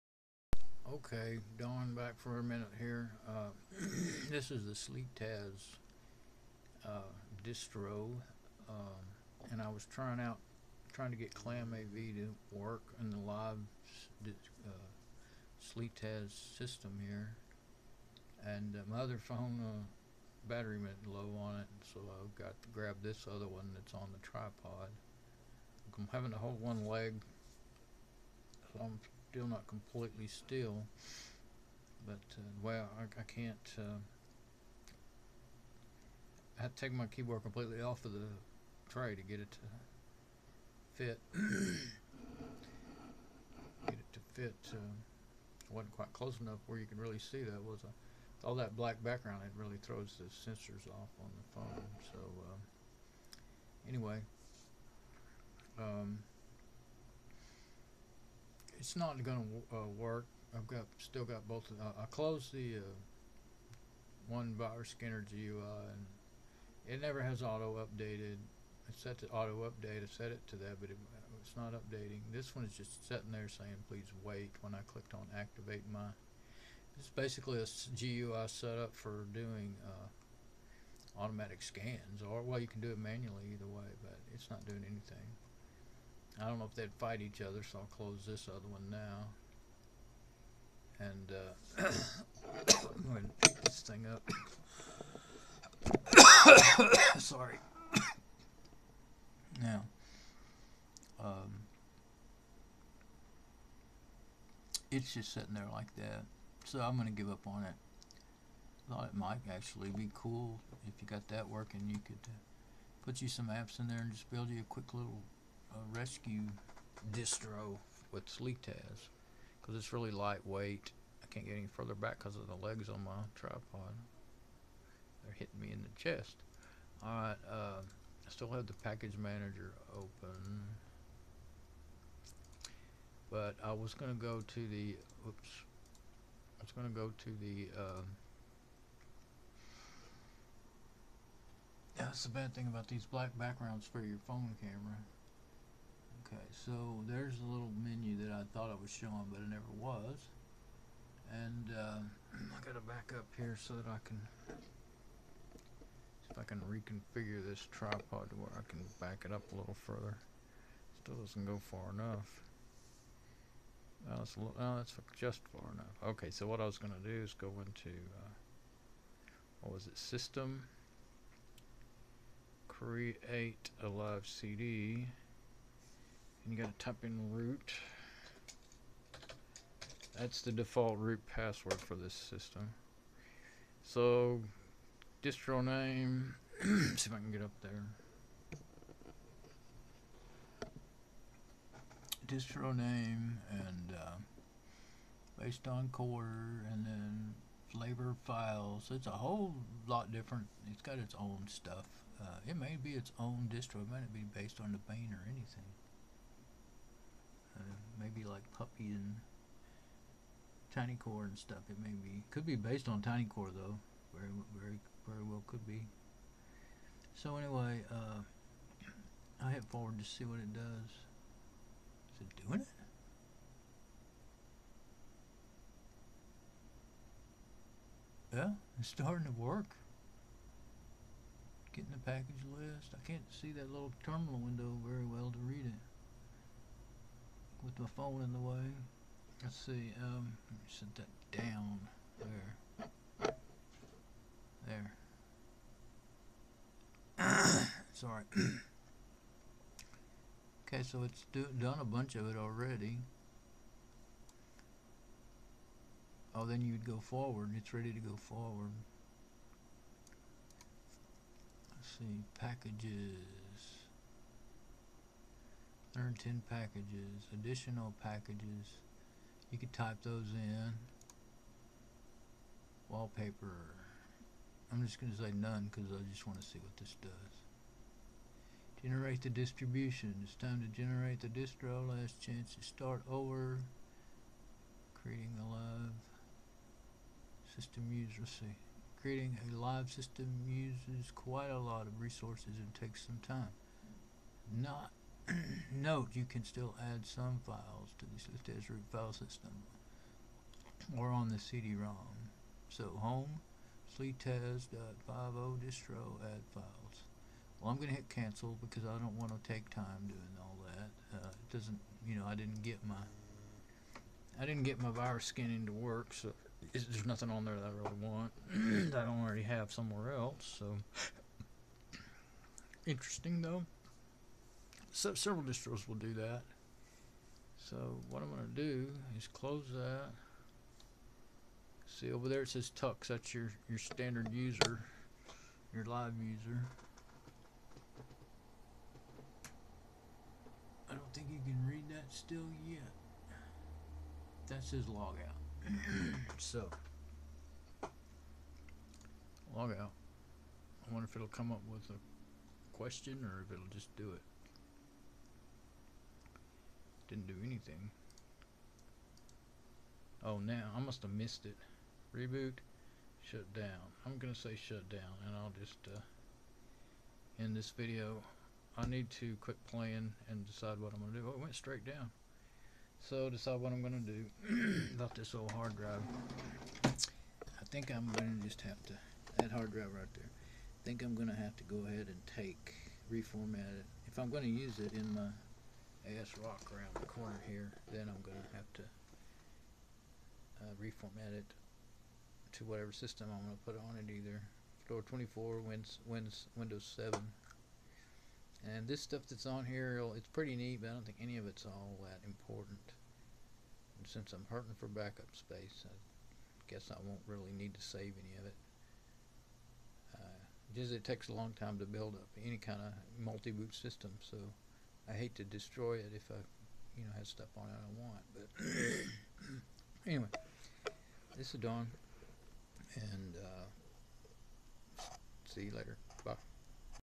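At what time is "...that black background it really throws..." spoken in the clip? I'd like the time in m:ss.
0:48.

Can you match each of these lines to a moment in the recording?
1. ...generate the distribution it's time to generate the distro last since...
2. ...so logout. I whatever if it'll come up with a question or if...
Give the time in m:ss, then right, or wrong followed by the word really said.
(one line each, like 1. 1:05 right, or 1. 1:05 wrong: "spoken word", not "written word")
1. 4:38 wrong: "chance", not "since"
2. 5:46 wrong: "wonder", not "whatever".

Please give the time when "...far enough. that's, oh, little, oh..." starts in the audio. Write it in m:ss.
2:41.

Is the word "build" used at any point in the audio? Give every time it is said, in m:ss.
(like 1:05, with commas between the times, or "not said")
1:54, 6:51.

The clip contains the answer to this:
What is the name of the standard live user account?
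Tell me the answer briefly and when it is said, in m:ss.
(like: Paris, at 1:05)
Tux, at 5:32.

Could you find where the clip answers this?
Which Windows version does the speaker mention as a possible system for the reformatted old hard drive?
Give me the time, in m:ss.
6:36.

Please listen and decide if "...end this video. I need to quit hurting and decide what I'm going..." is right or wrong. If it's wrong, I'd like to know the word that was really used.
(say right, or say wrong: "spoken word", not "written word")
wrong: "playing", not "hurting".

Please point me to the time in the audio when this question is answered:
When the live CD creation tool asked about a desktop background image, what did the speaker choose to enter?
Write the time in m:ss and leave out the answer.
4:35.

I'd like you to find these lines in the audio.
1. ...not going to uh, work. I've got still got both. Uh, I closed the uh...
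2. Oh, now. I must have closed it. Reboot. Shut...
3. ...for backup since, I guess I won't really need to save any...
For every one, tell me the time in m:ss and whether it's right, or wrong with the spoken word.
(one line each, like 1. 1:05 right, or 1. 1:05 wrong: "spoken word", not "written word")
1. 0:58 right
2. 6:00 wrong: "missed", not "closed"
3. 6:44 wrong: "space", not "since".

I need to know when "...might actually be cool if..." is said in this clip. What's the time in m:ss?
1:49.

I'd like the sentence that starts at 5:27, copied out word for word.
So what I'm going to do is close that.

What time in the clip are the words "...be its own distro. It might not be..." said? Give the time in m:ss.
3:22.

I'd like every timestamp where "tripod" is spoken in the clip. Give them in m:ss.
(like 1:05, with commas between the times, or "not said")
0:24, 2:03, 2:37.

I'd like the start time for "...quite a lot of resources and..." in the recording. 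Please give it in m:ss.
4:51.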